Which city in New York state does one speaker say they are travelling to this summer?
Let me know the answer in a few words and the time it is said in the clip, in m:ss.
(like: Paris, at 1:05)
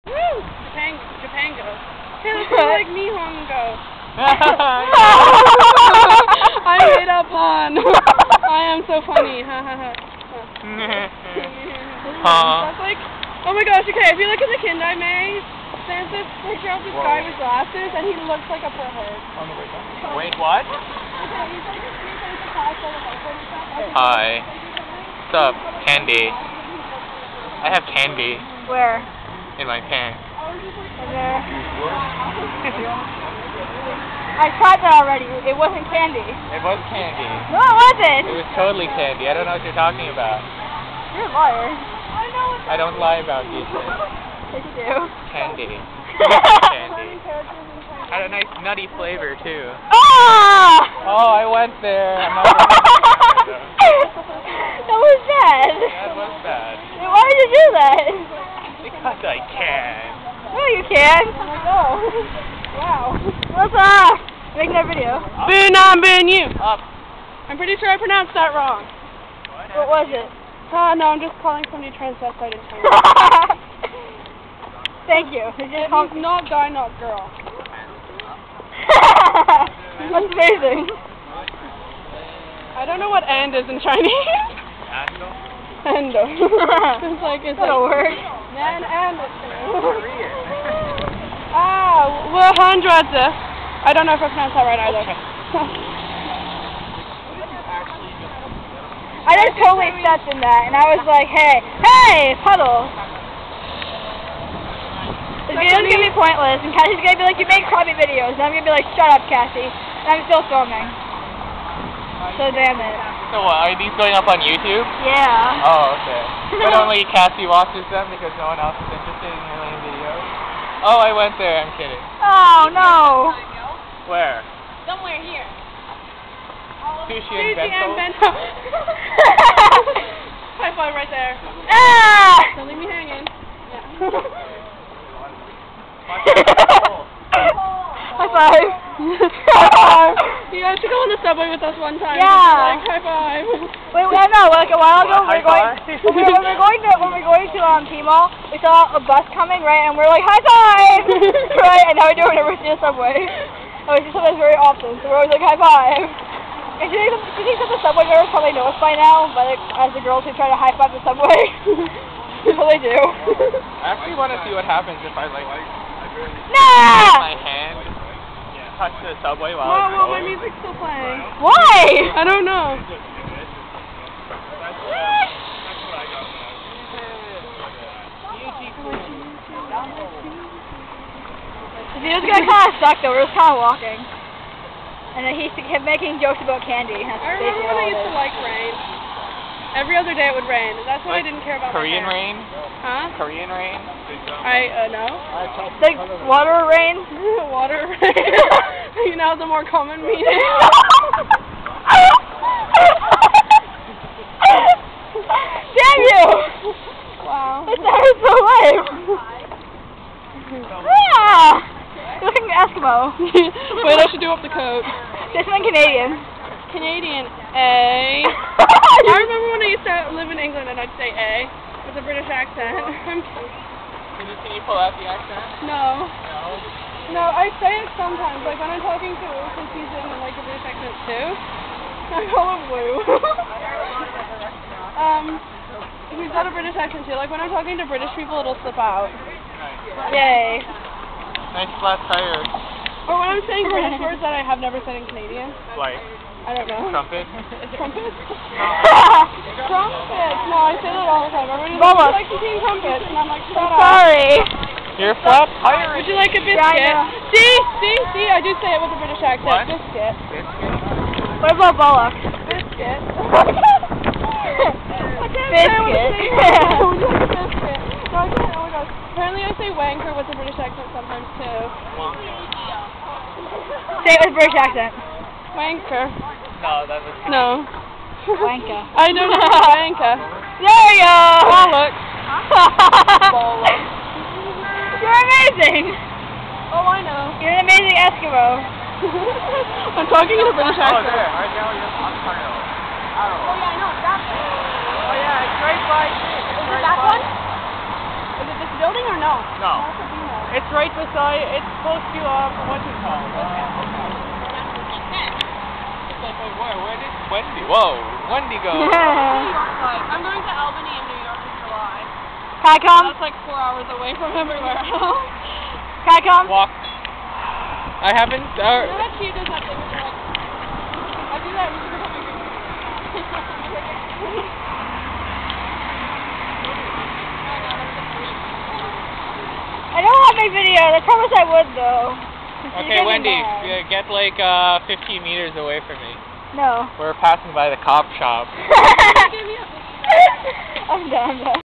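Albany, at 5:10.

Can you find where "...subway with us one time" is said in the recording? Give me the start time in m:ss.
2:21.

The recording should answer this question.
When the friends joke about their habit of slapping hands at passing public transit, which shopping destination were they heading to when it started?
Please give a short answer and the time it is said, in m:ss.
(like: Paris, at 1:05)
T-Mall, at 2:27.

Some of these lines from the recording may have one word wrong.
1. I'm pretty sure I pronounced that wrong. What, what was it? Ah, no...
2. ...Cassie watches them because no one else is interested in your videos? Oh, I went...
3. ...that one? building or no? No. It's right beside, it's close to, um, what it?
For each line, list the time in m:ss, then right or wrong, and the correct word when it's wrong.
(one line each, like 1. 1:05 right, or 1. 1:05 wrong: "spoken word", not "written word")
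1. 1:07 right
2. 1:57 right
3. 4:56 right.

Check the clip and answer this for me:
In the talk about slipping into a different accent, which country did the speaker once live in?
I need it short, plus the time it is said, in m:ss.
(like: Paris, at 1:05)
England, at 3:40.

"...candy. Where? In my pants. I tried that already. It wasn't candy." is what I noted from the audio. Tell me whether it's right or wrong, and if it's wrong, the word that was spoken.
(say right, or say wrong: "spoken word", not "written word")
right.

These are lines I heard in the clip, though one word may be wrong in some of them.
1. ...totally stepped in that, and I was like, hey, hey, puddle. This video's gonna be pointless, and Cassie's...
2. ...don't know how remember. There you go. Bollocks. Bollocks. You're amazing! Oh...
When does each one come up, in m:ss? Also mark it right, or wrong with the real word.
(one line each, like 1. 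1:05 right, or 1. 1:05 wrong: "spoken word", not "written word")
1. 1:39 right
2. 4:39 wrong: "wanker", not "remember".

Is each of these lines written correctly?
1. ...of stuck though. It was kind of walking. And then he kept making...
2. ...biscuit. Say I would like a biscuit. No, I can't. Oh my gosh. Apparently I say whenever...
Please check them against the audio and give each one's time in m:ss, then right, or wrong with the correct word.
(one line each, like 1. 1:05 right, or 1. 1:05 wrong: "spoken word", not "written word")
1. 3:02 right
2. 4:25 wrong: "wanker", not "whenever".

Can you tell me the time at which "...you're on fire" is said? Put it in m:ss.
4:51.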